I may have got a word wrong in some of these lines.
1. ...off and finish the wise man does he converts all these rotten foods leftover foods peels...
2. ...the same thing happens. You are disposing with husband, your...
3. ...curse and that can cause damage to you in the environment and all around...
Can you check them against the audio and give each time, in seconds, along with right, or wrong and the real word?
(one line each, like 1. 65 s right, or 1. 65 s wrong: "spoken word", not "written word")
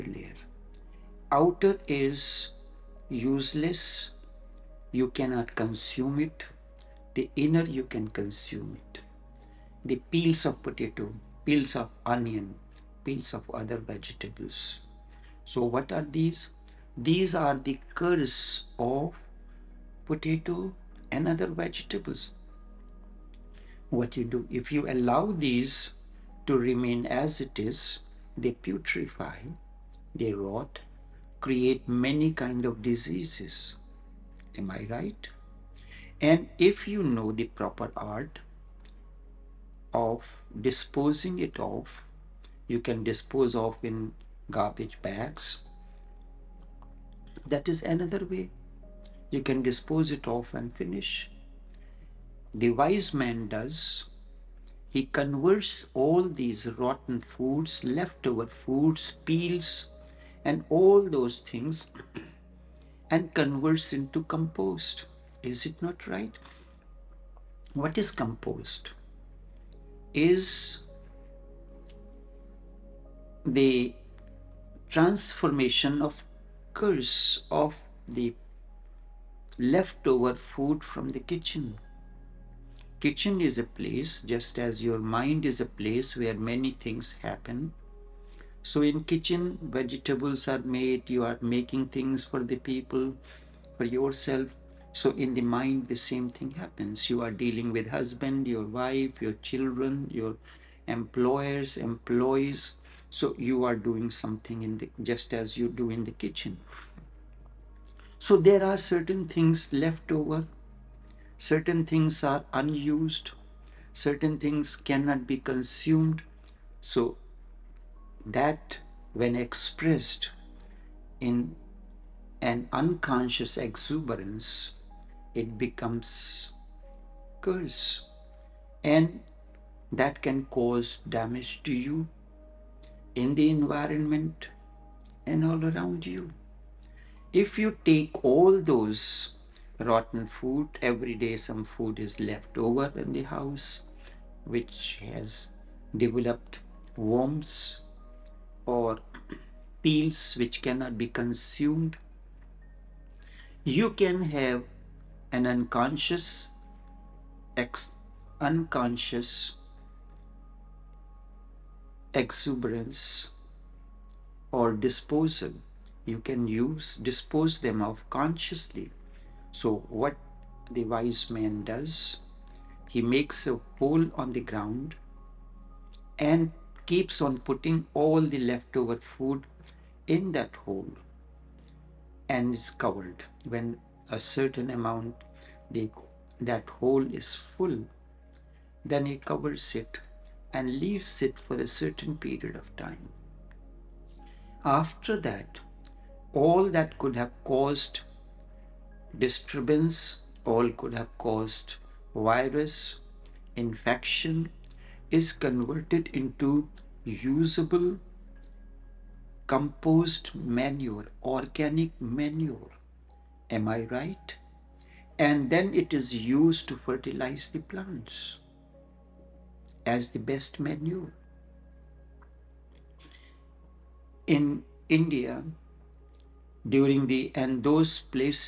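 1. 50 s right
2. 95 s wrong: "dealing", not "disposing"
3. 127 s right.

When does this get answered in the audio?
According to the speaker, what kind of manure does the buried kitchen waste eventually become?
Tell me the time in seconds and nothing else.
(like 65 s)
211 s.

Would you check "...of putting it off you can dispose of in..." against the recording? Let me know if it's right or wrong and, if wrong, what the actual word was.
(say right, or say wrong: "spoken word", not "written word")
wrong: "disposing", not "putting".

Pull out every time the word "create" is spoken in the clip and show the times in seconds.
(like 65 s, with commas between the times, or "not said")
31 s.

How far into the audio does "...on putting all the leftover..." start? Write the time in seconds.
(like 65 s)
177 s.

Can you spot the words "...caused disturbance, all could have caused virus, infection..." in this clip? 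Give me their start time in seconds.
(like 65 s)
197 s.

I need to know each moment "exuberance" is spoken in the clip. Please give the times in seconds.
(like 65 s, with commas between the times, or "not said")
123 s, 162 s.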